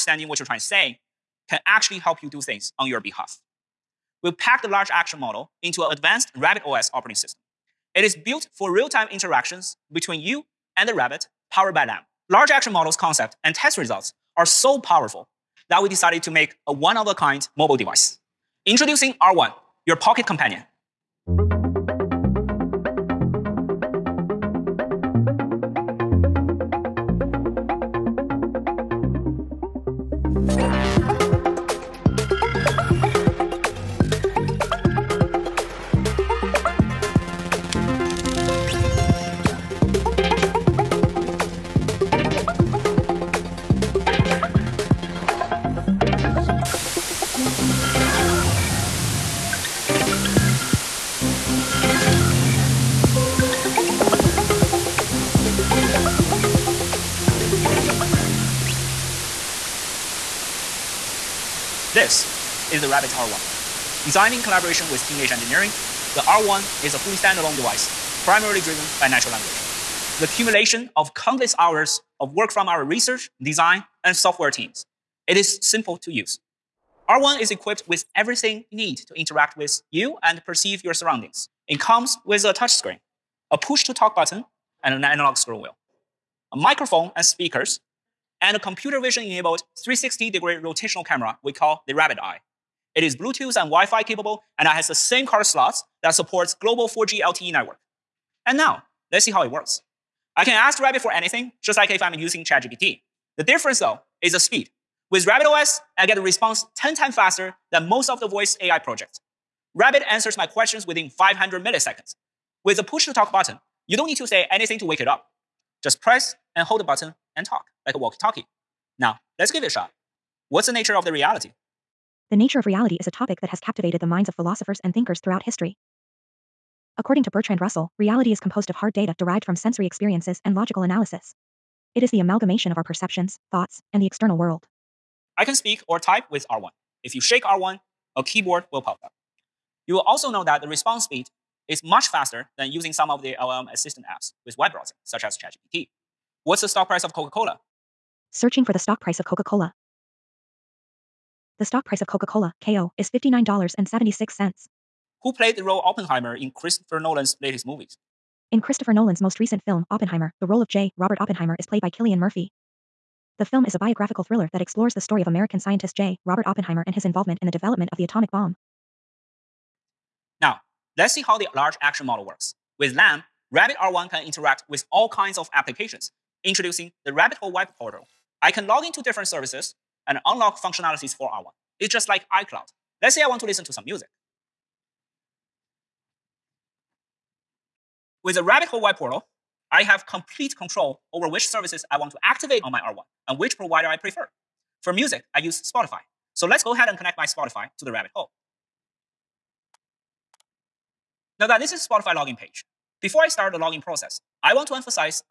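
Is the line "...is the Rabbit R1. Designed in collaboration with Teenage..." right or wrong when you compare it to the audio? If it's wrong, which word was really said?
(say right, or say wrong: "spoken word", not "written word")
right.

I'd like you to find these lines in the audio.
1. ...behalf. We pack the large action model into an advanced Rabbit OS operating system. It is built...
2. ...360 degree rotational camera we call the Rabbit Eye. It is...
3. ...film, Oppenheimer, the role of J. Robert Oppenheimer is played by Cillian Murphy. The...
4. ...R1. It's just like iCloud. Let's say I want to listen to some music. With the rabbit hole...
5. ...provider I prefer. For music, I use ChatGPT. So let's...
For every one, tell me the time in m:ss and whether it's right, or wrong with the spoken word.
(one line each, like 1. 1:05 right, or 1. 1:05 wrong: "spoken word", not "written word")
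1. 0:02 right
2. 1:29 right
3. 2:39 right
4. 3:01 right
5. 3:13 wrong: "Spotify", not "ChatGPT".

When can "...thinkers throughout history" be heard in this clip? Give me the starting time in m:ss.
2:04.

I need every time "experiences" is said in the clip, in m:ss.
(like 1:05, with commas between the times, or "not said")
2:09.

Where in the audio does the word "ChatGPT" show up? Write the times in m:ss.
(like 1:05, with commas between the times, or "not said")
1:42, 2:25.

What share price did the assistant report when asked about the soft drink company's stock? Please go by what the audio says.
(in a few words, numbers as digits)
$59.76.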